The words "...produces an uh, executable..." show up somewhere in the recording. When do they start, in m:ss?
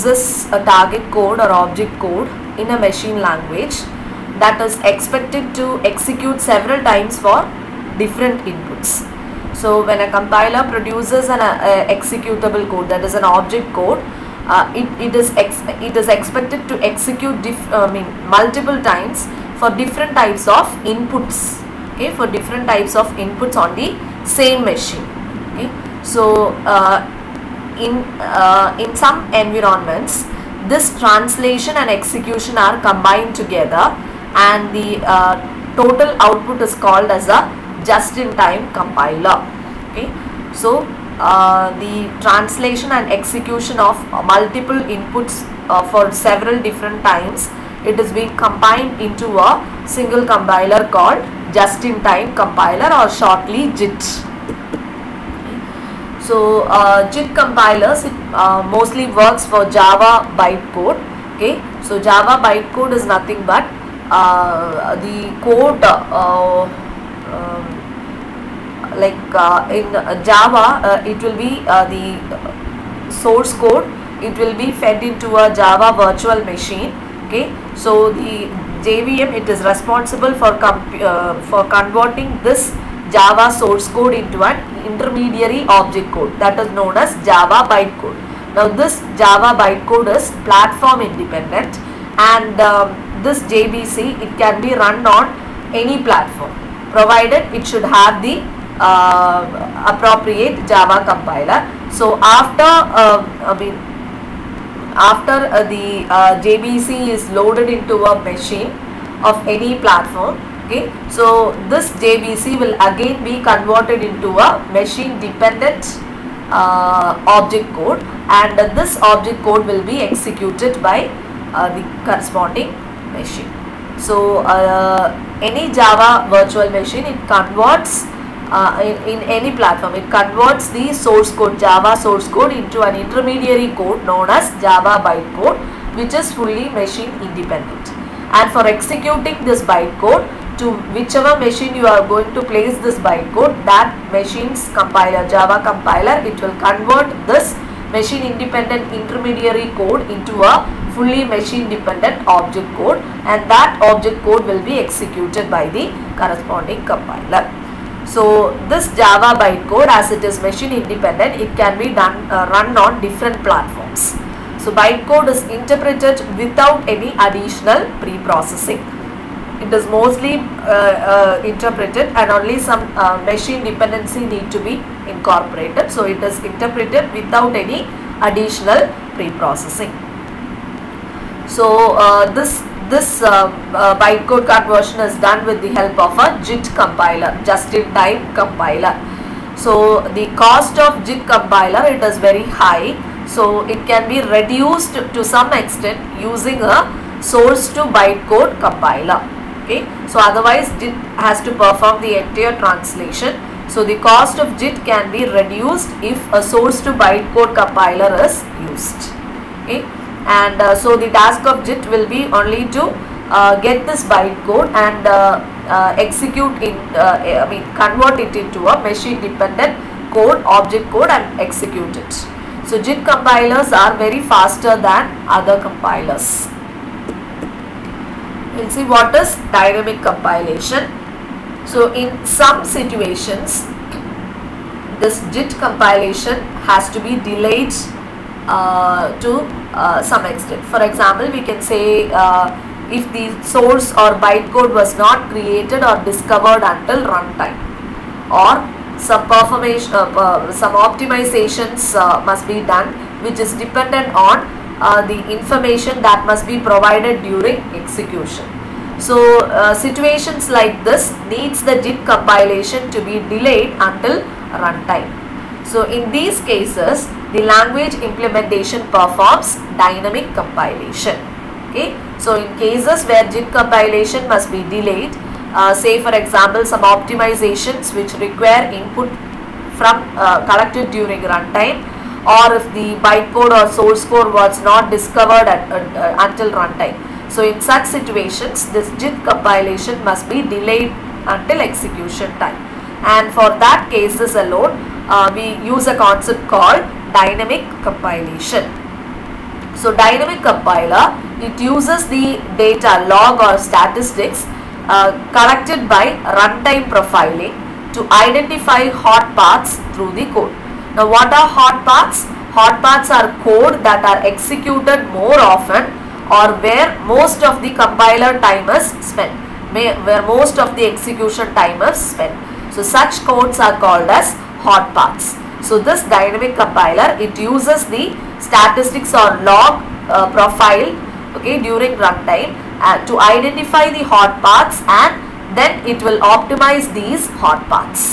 0:10.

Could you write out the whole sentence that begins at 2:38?
So this Java bytecode as it is machine independent it can be done uh, run on different platforms.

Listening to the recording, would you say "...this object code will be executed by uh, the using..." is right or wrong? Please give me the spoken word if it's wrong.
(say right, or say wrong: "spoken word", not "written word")
wrong: "corresponding", not "using".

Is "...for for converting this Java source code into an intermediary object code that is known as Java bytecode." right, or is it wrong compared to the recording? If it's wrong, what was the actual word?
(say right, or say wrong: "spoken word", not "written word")
right.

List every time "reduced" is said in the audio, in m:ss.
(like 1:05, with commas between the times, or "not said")
3:14, 3:25.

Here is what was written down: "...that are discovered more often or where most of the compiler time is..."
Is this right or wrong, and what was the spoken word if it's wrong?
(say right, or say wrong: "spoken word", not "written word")
wrong: "executed", not "discovered".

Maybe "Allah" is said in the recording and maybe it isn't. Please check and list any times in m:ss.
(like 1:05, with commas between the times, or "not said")
not said.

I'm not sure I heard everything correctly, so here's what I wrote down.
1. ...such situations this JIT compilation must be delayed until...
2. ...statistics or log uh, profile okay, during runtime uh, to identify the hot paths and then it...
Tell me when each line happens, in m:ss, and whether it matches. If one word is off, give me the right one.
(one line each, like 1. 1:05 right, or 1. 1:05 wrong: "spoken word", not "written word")
1. 4:47 right
2. 5:28 right.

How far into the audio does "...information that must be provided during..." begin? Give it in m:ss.
4:15.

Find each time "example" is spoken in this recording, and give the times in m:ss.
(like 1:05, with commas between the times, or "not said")
4:00, 4:36.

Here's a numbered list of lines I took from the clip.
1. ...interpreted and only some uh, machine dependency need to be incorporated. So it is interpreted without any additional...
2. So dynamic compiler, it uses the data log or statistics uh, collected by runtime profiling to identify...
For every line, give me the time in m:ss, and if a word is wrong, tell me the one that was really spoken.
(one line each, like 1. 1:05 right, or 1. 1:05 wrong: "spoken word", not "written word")
1. 2:51 right
2. 4:59 right.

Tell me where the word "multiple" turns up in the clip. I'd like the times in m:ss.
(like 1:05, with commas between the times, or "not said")
0:18, 0:44.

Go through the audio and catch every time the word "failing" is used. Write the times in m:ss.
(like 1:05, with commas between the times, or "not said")
not said.